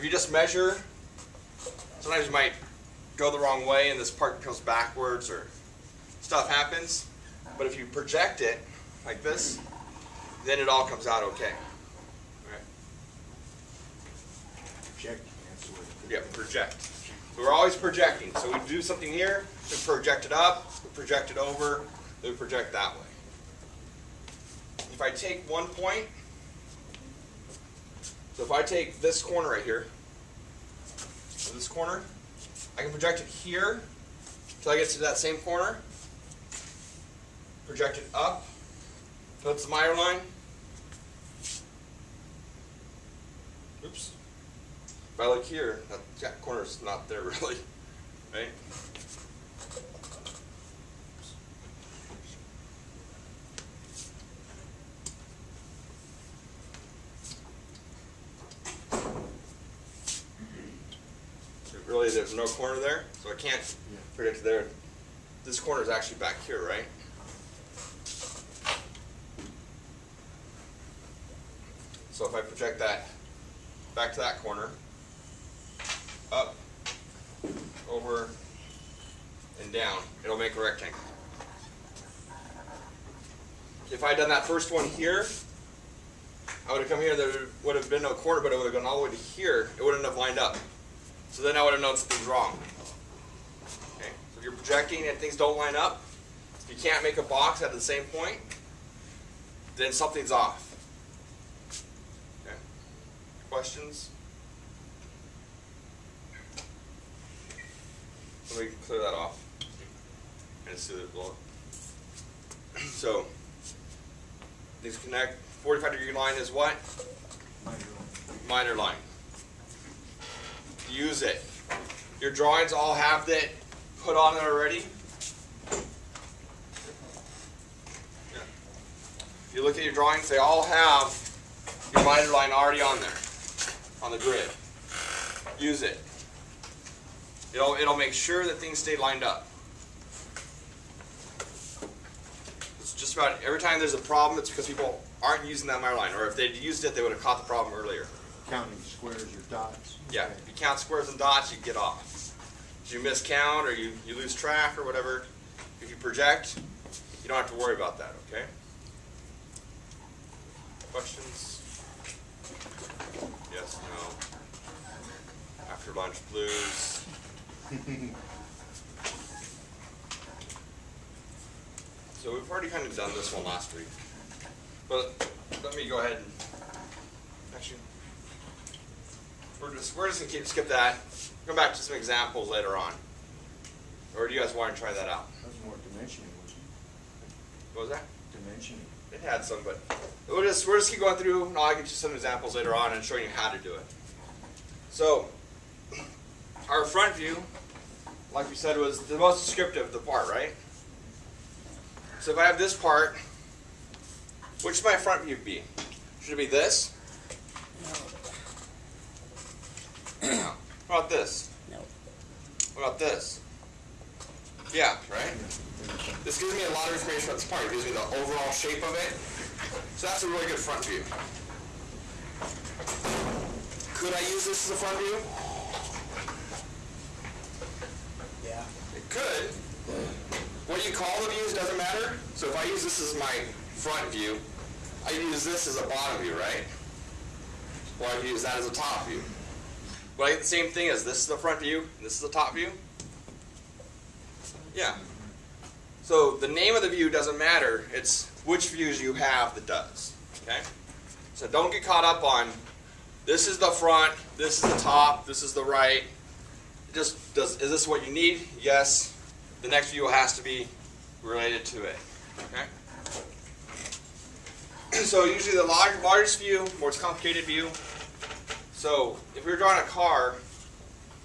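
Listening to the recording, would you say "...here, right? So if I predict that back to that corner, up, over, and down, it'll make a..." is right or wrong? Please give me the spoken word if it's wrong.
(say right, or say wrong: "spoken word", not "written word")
wrong: "project", not "predict".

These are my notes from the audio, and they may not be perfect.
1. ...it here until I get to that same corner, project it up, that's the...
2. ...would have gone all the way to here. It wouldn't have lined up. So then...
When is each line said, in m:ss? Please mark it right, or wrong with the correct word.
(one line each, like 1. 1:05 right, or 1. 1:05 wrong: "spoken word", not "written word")
1. 0:33 right
2. 1:28 right.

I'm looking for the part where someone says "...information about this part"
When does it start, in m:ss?
3:36.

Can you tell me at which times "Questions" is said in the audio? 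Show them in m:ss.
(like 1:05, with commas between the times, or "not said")
1:43, 2:40.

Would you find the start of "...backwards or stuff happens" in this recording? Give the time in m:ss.
0:04.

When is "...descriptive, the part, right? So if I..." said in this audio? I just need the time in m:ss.
3:19.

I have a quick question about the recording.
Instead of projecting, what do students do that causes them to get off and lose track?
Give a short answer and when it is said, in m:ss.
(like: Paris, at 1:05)
Counting squares or dots, at 2:28.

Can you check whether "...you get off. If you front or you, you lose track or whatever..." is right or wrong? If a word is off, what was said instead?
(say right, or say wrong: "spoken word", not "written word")
wrong: "miscount", not "front".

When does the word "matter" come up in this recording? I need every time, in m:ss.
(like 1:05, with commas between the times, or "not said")
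3:51, 4:07.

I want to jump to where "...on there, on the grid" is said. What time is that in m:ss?
2:12.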